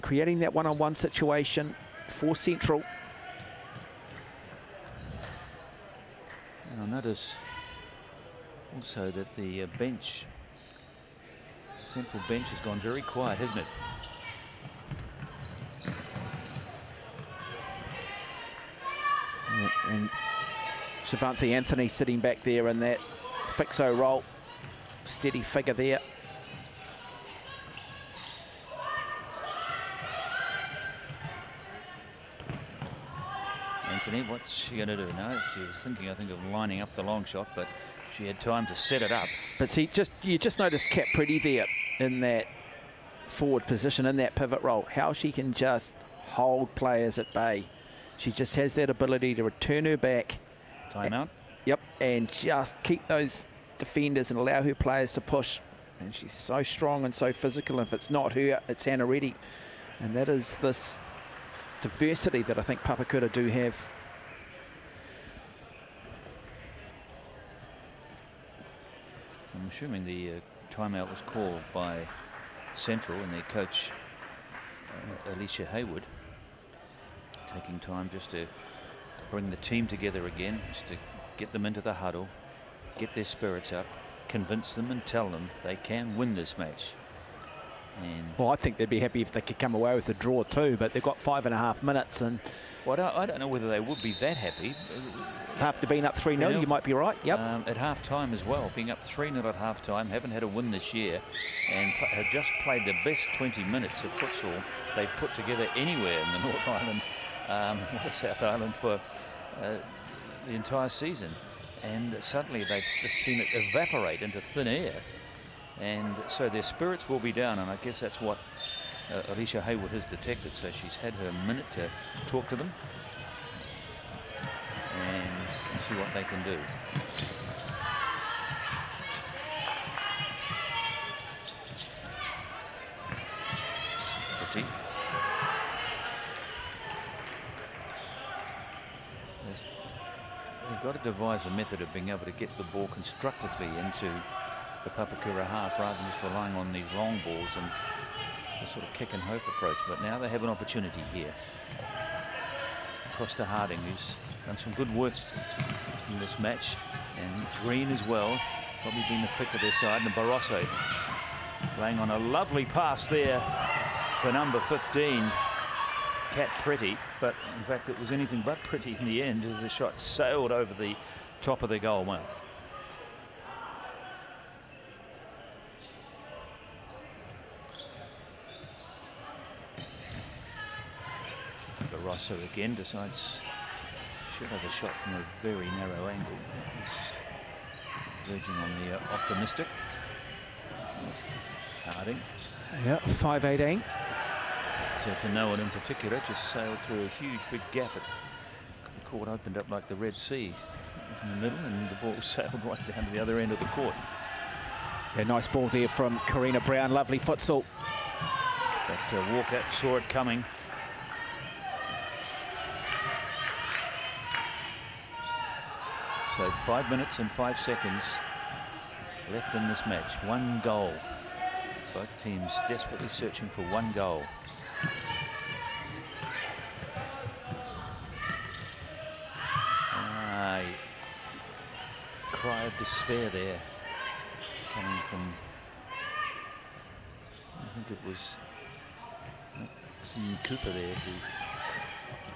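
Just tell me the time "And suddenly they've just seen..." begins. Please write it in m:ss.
1:51.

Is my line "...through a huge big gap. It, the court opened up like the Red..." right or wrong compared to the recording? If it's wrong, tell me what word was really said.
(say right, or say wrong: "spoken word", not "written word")
right.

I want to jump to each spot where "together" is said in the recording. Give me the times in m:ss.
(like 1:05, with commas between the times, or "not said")
1:19, 1:45.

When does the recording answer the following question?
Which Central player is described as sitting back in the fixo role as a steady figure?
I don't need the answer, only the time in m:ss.
0:21.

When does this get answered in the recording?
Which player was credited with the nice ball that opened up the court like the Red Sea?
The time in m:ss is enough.
3:26.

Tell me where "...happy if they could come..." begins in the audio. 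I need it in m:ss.
1:28.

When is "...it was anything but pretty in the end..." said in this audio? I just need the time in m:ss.
2:47.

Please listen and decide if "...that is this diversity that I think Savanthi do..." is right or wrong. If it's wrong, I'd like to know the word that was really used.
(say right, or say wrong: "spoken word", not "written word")
wrong: "Papakura", not "Savanthi".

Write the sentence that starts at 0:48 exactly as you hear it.
She just has that ability to return her back.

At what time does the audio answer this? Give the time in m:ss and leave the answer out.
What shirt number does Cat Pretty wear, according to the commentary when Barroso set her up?
2:44.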